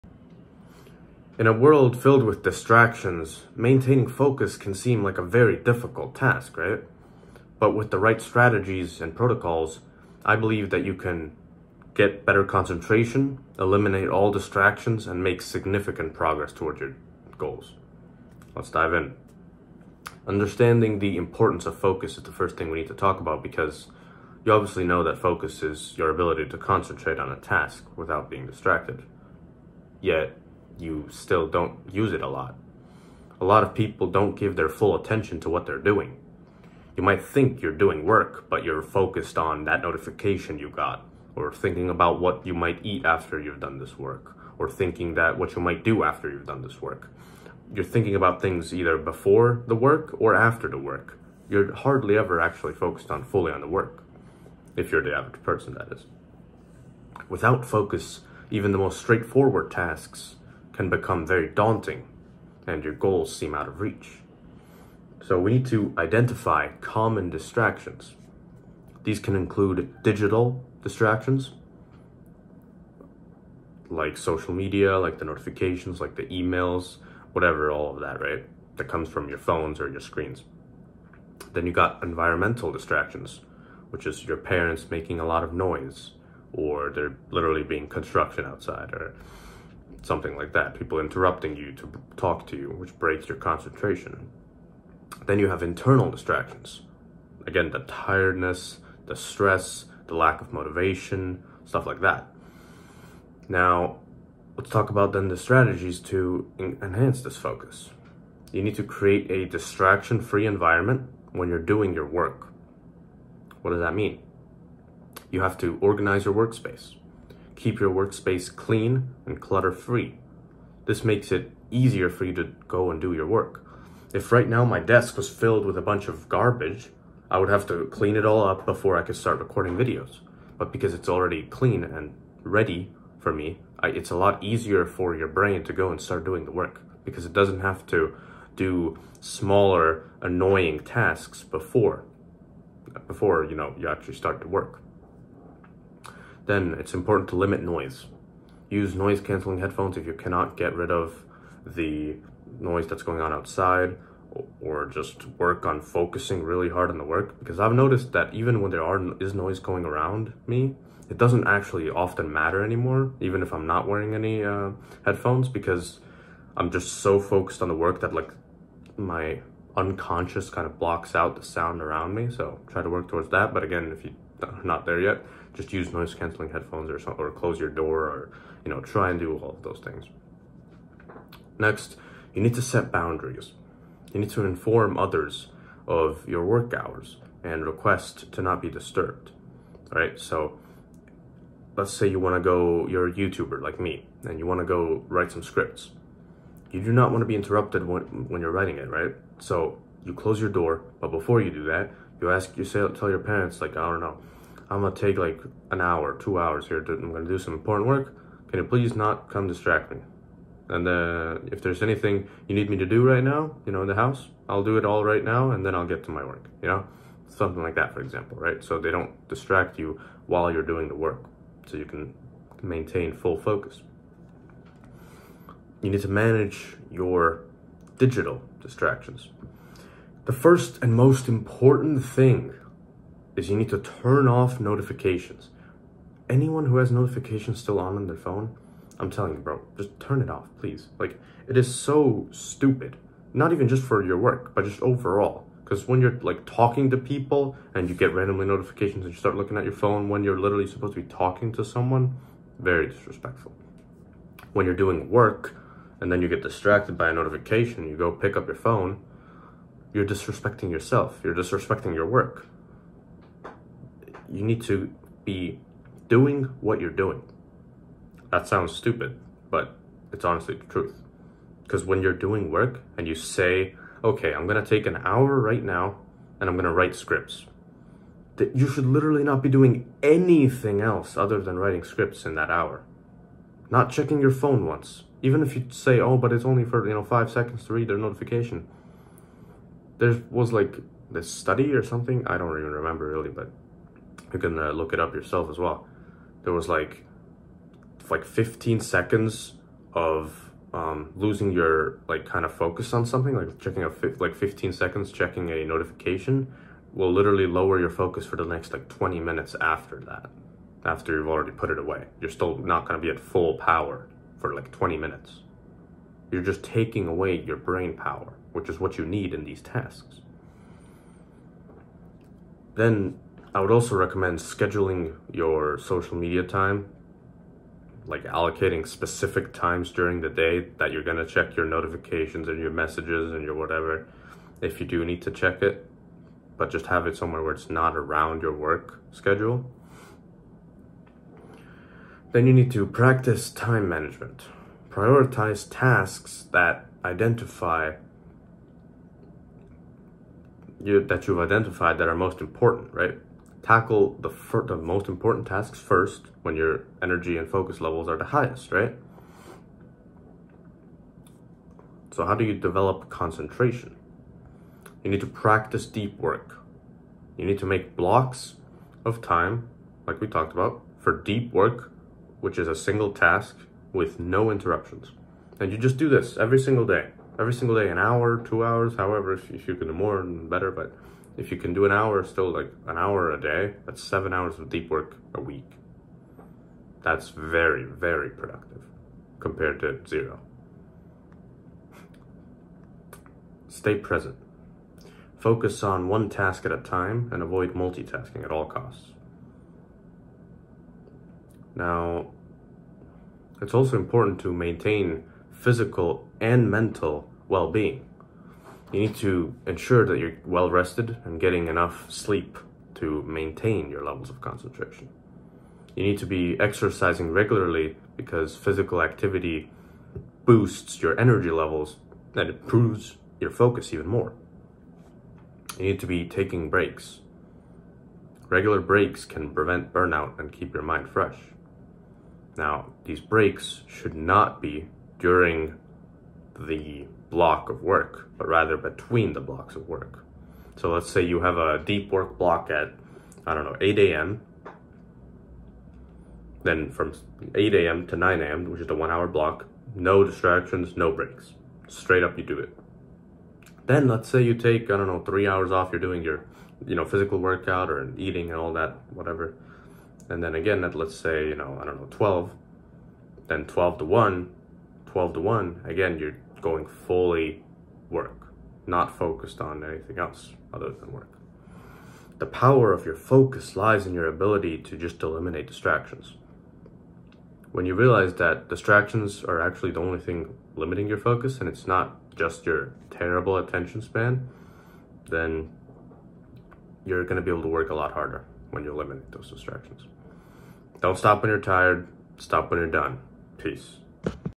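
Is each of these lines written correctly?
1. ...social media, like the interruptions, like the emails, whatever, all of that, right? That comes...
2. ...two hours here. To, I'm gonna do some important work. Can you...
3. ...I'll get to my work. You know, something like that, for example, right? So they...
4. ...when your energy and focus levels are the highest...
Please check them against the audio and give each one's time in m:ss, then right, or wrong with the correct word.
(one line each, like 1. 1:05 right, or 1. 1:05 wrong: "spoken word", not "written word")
1. 1:14 wrong: "notifications", not "interruptions"
2. 3:26 right
3. 3:35 right
4. 5:56 right.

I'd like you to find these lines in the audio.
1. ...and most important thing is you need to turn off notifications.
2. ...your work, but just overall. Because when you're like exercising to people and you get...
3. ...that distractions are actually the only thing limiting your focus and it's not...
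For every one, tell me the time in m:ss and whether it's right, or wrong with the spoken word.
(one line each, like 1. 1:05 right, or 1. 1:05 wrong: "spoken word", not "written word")
1. 3:50 right
2. 4:04 wrong: "talking", not "exercising"
3. 7:58 right.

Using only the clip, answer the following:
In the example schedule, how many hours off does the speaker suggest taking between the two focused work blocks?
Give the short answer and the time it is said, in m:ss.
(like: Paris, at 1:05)
3 hours, at 7:35.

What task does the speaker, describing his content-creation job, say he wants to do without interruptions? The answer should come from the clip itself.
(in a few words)
Write scripts.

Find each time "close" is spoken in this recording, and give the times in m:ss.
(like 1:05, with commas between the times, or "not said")
2:57, 3:20.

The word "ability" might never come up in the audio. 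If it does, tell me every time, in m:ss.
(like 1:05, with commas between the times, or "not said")
0:26, 7:54.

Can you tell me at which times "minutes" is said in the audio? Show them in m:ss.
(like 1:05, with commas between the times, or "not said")
5:09, 5:14.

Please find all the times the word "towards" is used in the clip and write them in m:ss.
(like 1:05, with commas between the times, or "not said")
0:16, 2:53.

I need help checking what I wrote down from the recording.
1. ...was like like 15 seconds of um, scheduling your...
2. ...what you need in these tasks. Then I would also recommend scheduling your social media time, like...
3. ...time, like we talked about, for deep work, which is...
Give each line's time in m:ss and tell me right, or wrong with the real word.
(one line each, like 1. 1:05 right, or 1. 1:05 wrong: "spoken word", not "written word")
1. 4:56 wrong: "losing", not "scheduling"
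2. 5:18 right
3. 6:09 right.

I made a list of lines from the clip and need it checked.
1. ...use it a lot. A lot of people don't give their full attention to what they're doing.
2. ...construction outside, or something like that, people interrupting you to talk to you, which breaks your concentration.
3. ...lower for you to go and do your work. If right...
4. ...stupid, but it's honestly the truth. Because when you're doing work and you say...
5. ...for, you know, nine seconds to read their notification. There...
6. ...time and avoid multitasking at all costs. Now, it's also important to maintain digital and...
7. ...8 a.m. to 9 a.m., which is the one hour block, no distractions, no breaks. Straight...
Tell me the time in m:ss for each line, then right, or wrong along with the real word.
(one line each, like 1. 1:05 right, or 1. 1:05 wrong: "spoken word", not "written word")
1. 0:31 right
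2. 1:27 right
3. 2:01 wrong: "easier", not "lower"
4. 4:28 right
5. 4:46 wrong: "five", not "nine"
6. 6:36 wrong: "physical", not "digital"
7. 7:27 right.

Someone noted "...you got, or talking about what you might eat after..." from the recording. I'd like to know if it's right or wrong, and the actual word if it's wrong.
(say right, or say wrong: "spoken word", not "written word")
wrong: "thinking", not "talking".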